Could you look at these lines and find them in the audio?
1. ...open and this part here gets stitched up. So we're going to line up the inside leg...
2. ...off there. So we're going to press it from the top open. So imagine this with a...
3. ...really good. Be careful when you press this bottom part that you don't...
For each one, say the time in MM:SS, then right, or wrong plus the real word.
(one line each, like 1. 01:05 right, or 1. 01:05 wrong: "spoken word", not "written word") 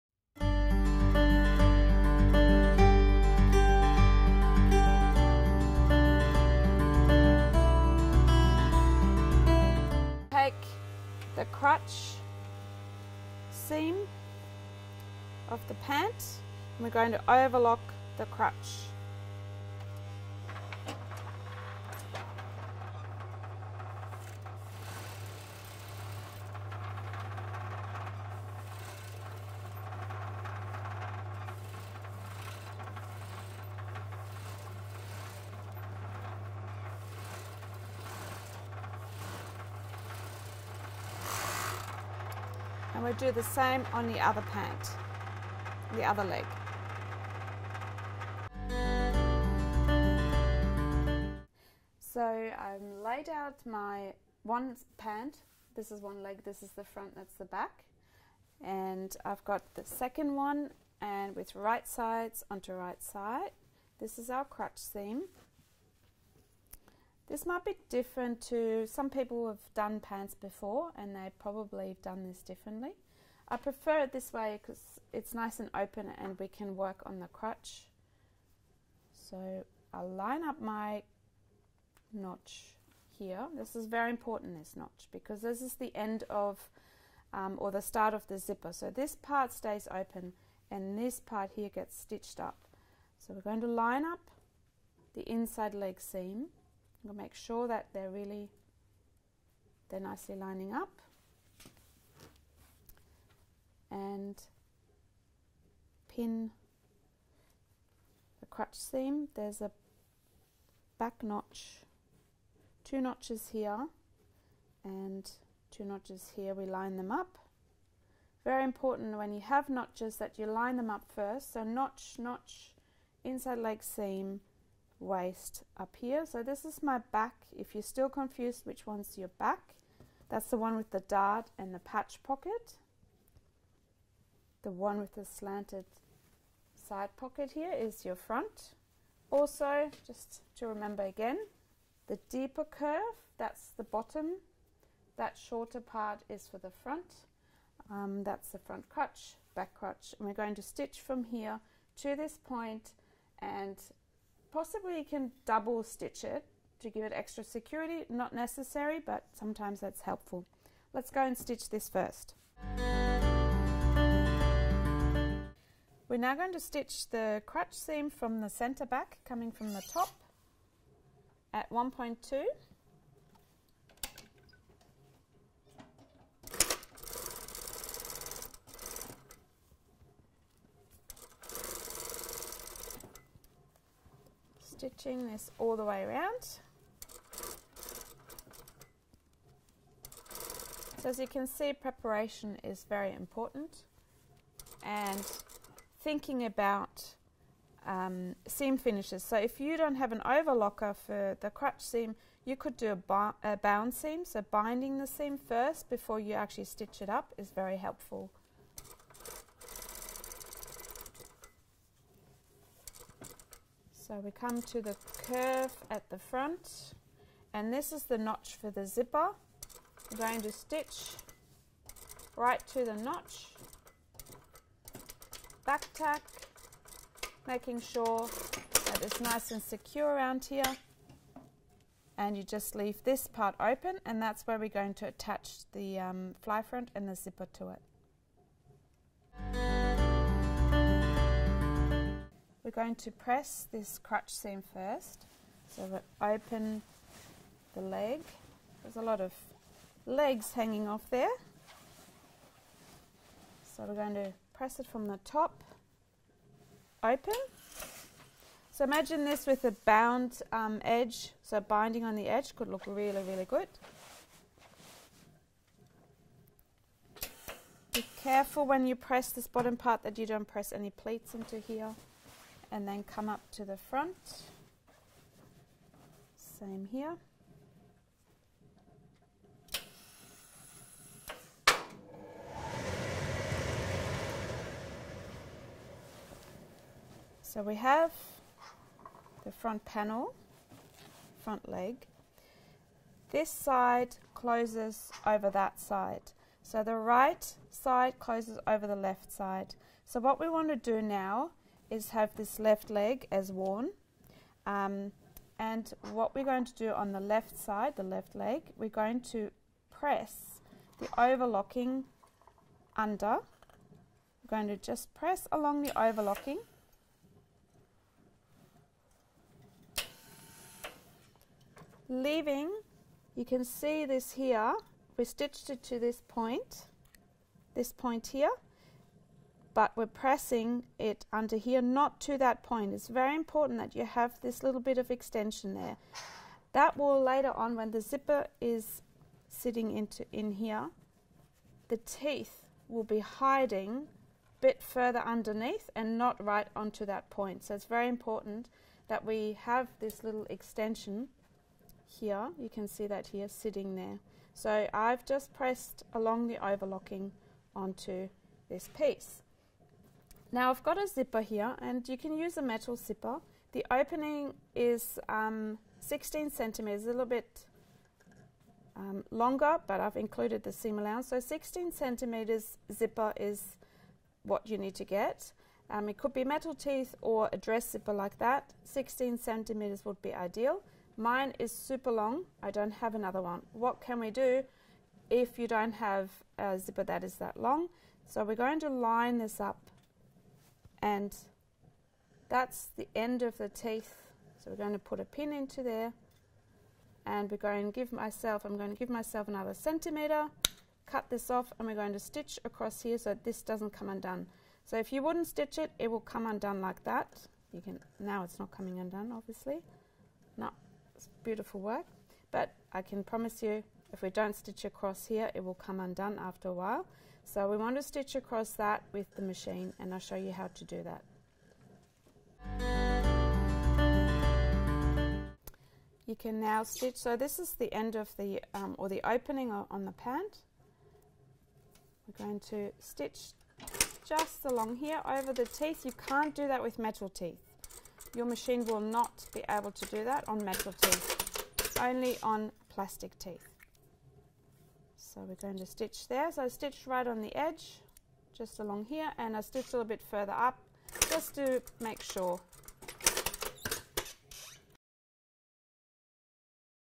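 1. 01:29 right
2. 04:10 right
3. 04:23 right.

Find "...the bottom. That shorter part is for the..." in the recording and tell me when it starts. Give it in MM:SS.
02:23.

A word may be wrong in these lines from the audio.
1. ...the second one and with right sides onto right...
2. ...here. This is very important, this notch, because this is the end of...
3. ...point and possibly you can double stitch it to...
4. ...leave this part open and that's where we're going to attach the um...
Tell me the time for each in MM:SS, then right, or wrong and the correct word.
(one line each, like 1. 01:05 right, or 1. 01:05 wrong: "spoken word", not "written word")
1. 00:59 right
2. 01:23 right
3. 02:32 right
4. 03:52 right.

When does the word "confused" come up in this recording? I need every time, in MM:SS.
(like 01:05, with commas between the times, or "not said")
02:08.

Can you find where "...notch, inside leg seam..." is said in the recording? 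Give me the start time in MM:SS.
02:02.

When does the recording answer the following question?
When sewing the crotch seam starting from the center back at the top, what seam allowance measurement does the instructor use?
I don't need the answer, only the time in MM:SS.
02:51.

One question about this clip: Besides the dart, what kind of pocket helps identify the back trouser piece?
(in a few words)
patch pocket.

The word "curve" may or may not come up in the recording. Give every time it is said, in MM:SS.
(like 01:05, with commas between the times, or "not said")
02:22, 03:35.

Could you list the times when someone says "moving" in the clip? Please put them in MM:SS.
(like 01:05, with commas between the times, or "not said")
not said.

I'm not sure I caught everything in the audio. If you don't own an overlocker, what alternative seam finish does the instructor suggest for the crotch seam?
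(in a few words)
bound seam.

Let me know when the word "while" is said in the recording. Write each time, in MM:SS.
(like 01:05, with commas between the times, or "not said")
06:56.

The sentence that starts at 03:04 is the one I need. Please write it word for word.
Stitching this all the way around.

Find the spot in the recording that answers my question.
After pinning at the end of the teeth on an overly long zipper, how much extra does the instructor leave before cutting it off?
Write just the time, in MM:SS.
06:39.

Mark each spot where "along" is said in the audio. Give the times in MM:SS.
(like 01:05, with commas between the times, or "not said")
05:15, 05:56, 07:14, 07:28.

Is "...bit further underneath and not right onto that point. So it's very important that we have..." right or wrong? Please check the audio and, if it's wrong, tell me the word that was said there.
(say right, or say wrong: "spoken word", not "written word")
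right.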